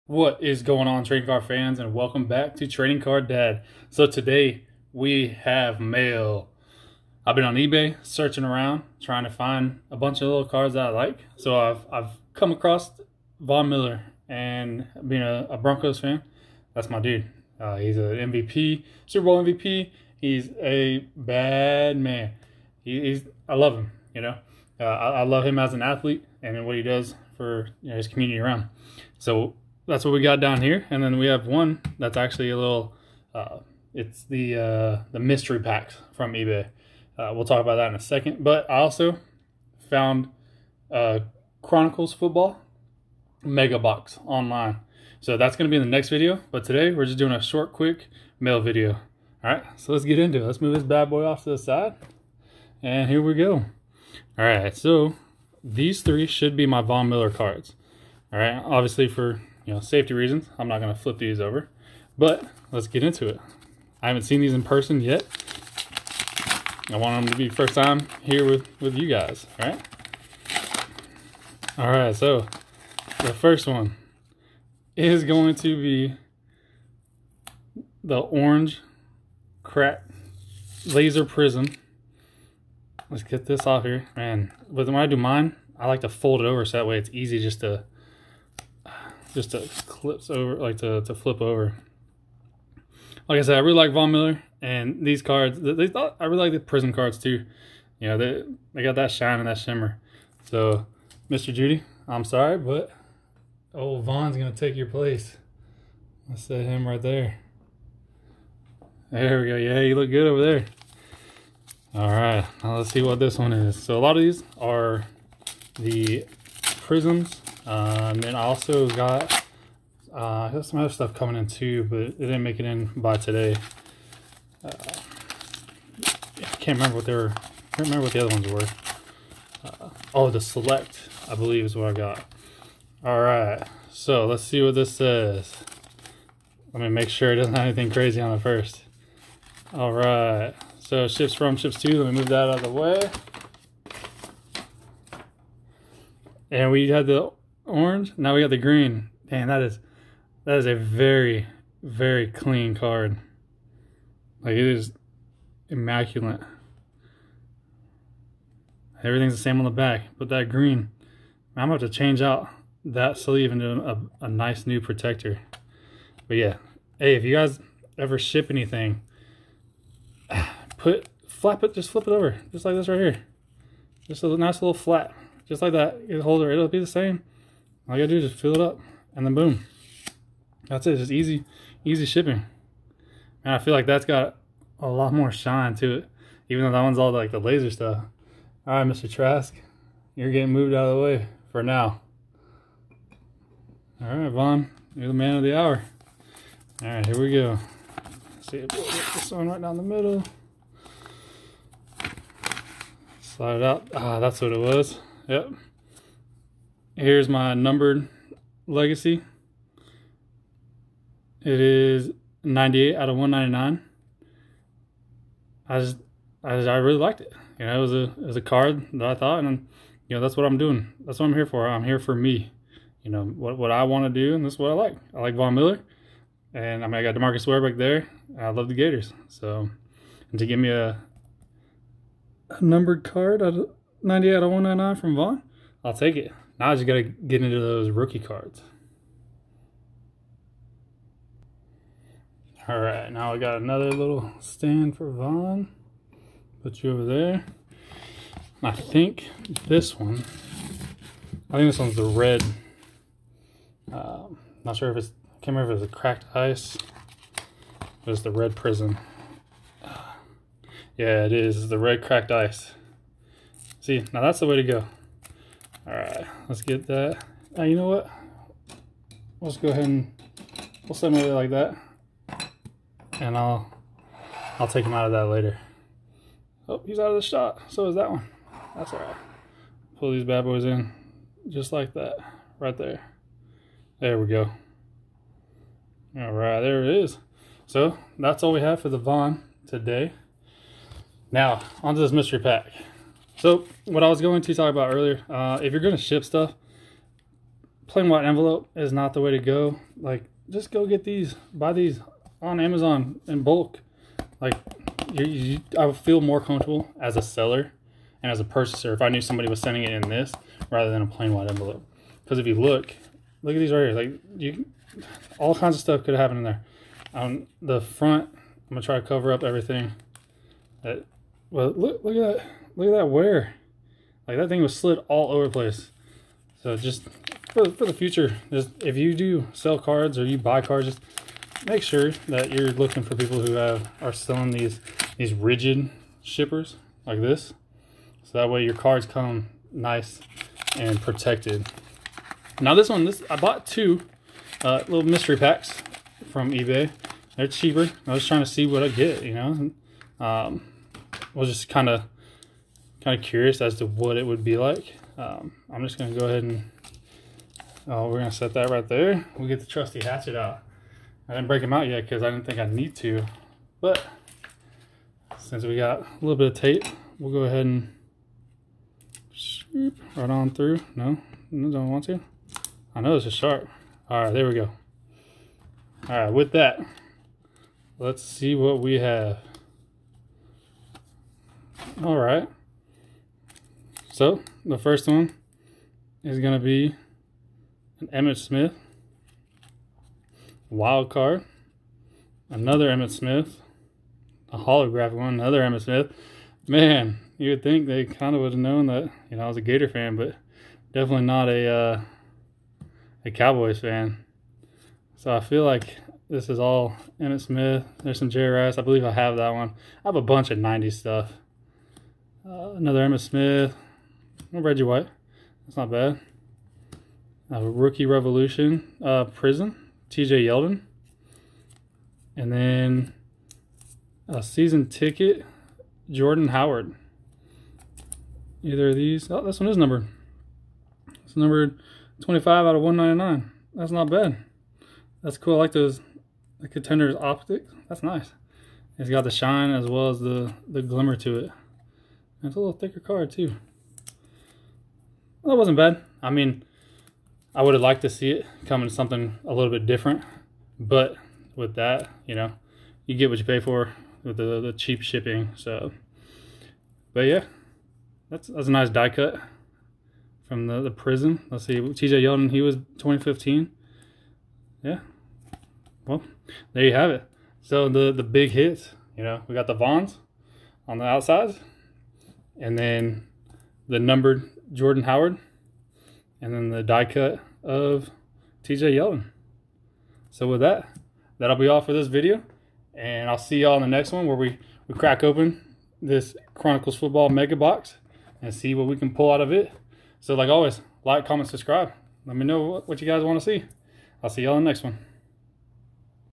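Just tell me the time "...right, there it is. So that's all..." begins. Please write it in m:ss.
4:46.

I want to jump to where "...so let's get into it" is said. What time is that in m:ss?
0:49.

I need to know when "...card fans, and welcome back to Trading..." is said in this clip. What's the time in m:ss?
0:01.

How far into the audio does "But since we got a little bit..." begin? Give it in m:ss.
6:03.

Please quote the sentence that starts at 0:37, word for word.
Uh, we'll talk about that in a second.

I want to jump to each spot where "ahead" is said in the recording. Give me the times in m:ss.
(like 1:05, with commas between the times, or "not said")
4:29, 5:56, 6:07.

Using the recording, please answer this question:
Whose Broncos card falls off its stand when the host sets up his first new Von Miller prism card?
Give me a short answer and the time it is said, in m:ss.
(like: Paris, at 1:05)
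Jeudy, at 1:41.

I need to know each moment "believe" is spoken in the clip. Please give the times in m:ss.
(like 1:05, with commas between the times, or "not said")
2:11, 6:48.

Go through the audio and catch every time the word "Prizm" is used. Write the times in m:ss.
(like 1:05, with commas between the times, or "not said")
6:59, 7:40.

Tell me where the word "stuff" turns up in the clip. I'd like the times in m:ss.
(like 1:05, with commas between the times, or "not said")
2:00, 3:07, 4:56, 5:15, 6:50.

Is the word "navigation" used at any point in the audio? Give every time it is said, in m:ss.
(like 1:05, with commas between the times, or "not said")
not said.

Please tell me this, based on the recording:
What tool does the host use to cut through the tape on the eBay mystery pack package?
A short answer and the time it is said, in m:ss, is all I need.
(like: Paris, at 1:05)
hatchet, at 6:00.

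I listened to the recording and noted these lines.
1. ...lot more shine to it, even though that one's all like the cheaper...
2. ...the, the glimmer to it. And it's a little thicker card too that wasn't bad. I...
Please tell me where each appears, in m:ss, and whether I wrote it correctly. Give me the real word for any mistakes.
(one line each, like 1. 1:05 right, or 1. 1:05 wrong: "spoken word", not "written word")
1. 3:04 wrong: "laser", not "cheaper"
2. 7:20 right.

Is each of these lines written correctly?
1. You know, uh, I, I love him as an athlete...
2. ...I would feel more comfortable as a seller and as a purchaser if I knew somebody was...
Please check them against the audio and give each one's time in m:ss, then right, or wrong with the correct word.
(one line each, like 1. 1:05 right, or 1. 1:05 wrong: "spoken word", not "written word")
1. 0:24 right
2. 5:05 right.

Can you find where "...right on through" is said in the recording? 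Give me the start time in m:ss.
6:10.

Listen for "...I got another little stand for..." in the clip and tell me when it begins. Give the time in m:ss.
4:03.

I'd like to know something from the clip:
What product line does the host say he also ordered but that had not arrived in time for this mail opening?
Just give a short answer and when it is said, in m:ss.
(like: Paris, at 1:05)
Select, at 2:10.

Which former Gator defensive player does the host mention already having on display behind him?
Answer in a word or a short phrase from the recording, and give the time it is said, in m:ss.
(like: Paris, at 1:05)
DeMarcus Ware, at 3:47.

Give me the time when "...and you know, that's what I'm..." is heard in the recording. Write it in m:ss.
3:39.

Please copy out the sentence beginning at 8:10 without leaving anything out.
So like always, like, comment, subscribe.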